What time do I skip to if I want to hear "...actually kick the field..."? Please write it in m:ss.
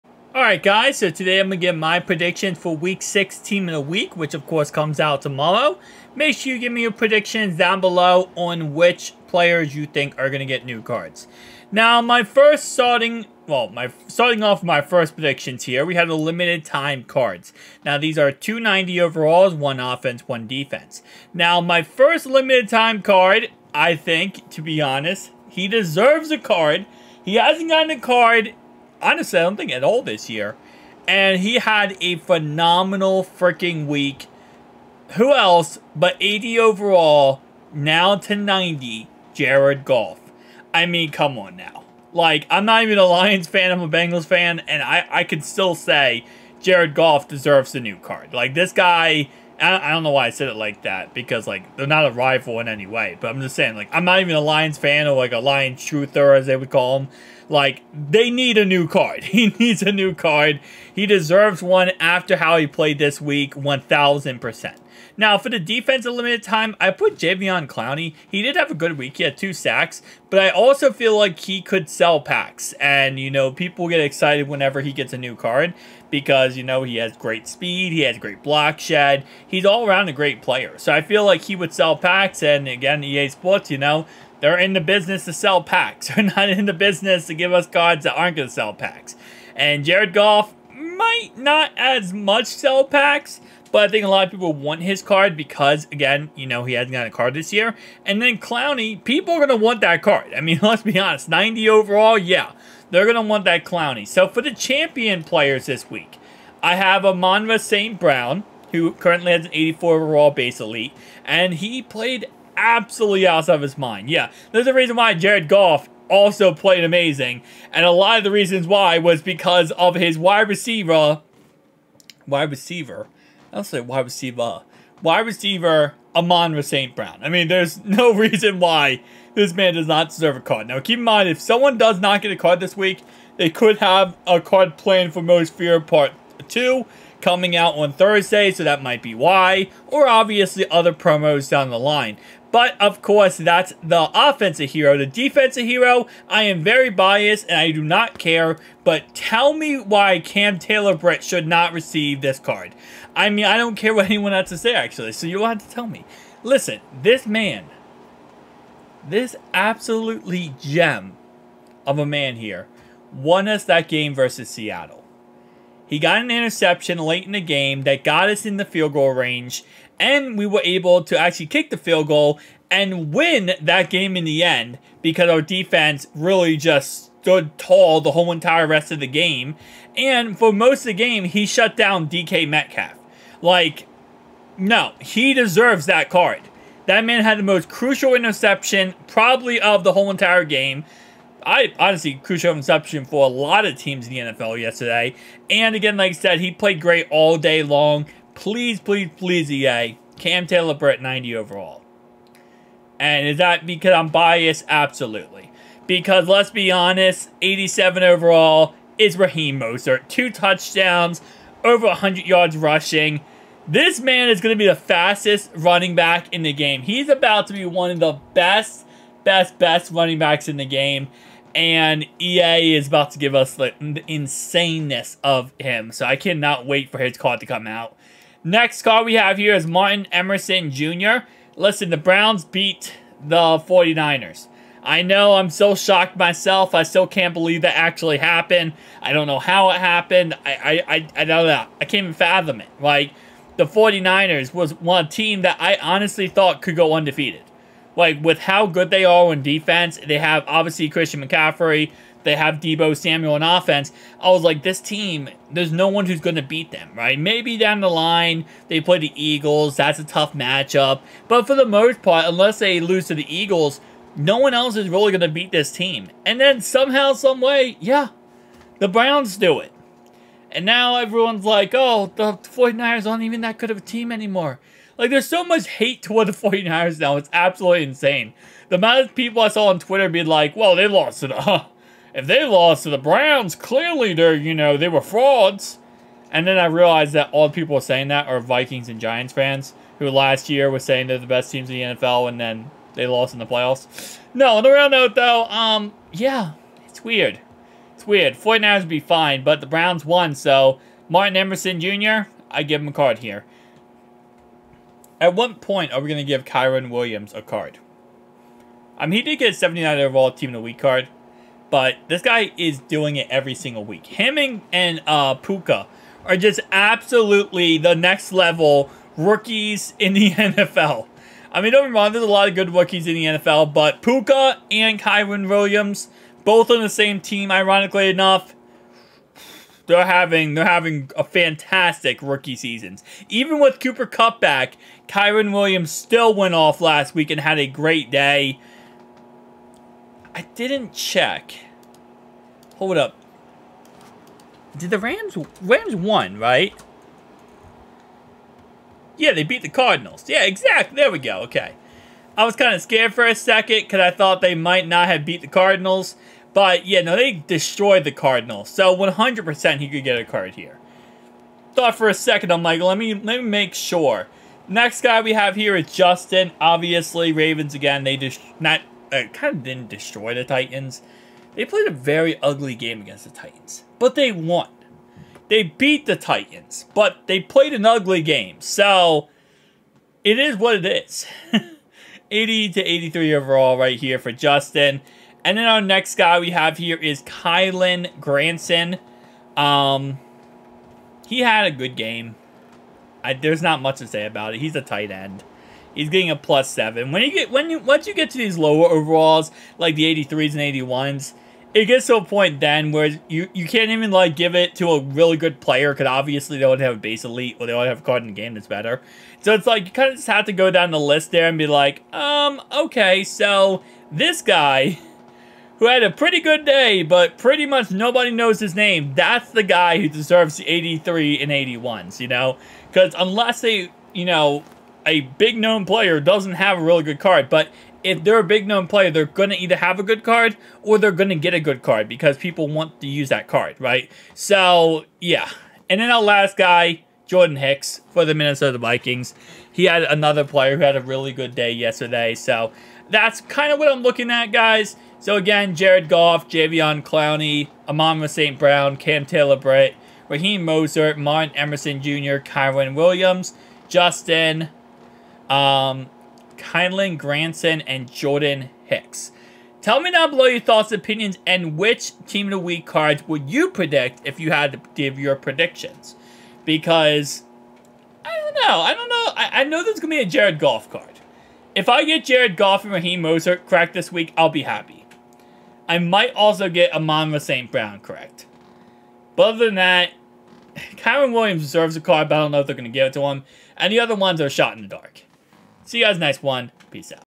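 2:51.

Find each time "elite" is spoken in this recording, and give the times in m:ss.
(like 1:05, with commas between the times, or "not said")
1:50, 6:47.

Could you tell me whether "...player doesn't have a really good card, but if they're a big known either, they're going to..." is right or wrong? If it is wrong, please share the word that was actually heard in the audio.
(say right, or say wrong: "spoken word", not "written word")
wrong: "player", not "either".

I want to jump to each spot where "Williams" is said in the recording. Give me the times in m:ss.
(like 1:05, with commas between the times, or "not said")
5:06, 5:25, 5:35, 7:32, 8:01.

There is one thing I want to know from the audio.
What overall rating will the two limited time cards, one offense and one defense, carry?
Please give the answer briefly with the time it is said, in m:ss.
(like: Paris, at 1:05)
90, at 0:18.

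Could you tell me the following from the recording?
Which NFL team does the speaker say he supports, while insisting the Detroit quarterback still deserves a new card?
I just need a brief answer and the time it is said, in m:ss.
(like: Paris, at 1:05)
Bengals, at 0:43.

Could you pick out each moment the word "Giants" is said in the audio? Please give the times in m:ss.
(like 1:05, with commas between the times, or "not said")
4:48.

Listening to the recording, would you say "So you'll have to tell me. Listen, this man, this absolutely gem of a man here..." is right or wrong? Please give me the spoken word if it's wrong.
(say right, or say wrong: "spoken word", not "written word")
right.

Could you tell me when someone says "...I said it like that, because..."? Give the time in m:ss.
0:50.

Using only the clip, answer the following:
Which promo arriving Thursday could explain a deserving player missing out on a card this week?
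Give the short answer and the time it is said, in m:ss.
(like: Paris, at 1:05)
Most Feared Part 2, at 2:15.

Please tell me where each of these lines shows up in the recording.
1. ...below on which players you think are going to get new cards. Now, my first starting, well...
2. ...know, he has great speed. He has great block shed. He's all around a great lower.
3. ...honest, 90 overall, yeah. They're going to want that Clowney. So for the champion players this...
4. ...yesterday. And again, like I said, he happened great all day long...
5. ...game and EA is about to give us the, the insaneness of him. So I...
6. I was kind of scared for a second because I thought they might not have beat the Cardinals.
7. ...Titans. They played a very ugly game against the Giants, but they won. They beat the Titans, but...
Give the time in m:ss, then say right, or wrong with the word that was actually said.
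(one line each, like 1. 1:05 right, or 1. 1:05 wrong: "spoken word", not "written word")
1. 0:07 right
2. 1:16 wrong: "player", not "lower"
3. 1:40 right
4. 3:14 wrong: "played", not "happened"
5. 3:40 right
6. 5:52 right
7. 6:10 wrong: "Titans", not "Giants".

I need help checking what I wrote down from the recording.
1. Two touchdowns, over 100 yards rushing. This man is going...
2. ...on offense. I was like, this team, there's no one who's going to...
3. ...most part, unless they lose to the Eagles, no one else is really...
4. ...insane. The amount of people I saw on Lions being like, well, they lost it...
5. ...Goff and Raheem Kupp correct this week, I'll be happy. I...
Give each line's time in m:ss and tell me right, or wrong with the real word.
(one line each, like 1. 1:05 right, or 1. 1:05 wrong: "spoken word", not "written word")
1. 3:30 right
2. 4:13 right
3. 4:21 right
4. 4:37 wrong: "Twitter", not "Lions"
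5. 7:52 wrong: "Mostert", not "Kupp".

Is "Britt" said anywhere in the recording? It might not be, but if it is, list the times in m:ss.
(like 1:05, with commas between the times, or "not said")
2:30, 3:20, 7:29.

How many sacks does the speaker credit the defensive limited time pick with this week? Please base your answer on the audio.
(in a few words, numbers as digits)
2.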